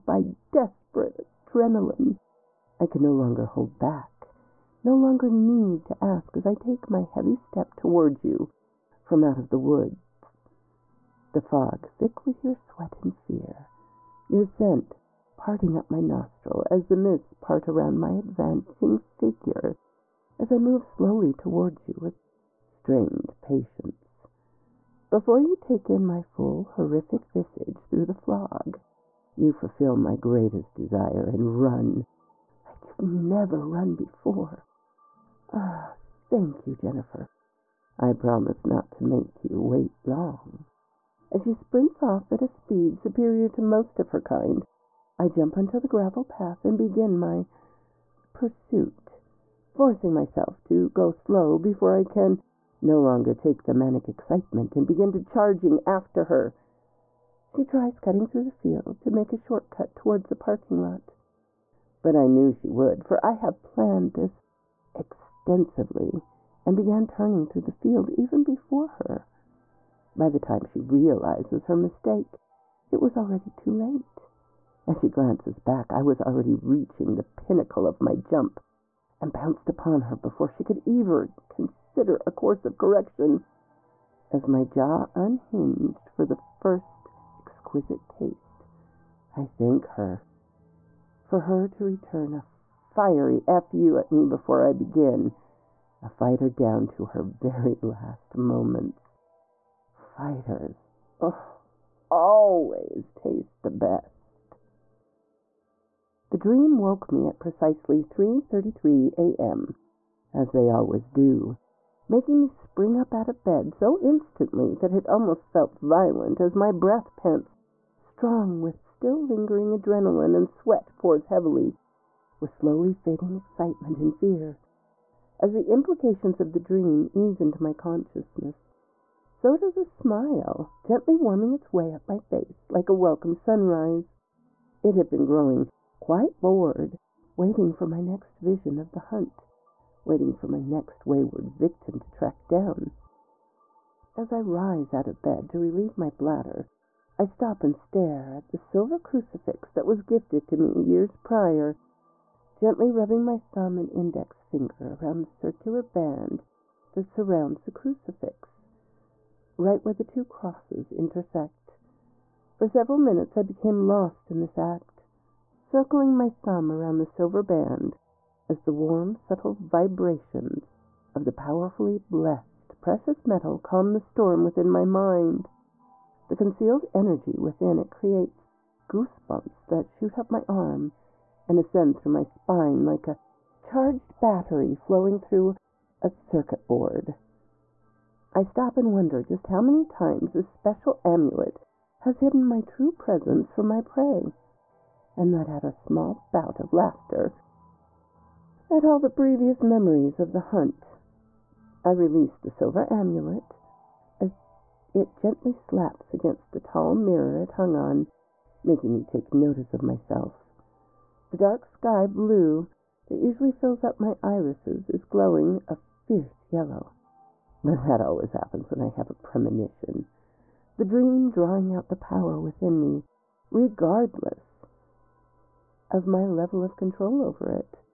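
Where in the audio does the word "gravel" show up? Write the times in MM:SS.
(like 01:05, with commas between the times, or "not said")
00:45.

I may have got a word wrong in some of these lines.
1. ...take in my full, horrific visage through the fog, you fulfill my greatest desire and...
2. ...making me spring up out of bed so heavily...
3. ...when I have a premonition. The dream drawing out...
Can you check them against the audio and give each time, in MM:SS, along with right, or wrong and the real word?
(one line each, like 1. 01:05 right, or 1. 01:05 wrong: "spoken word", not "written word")
1. 00:25 right
2. 01:52 wrong: "instantly", not "heavily"
3. 03:38 right.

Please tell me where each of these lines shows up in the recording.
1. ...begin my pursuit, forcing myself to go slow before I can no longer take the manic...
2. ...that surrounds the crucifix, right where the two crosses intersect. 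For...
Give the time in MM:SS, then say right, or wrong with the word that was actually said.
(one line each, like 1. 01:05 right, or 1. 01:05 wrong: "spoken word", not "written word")
1. 00:46 right
2. 02:36 right.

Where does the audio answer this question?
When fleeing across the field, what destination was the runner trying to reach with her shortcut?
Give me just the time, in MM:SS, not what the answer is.
01:00.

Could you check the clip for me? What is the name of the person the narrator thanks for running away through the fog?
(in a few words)
Jennifer.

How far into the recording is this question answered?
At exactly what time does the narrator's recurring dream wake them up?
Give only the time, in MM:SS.
01:48.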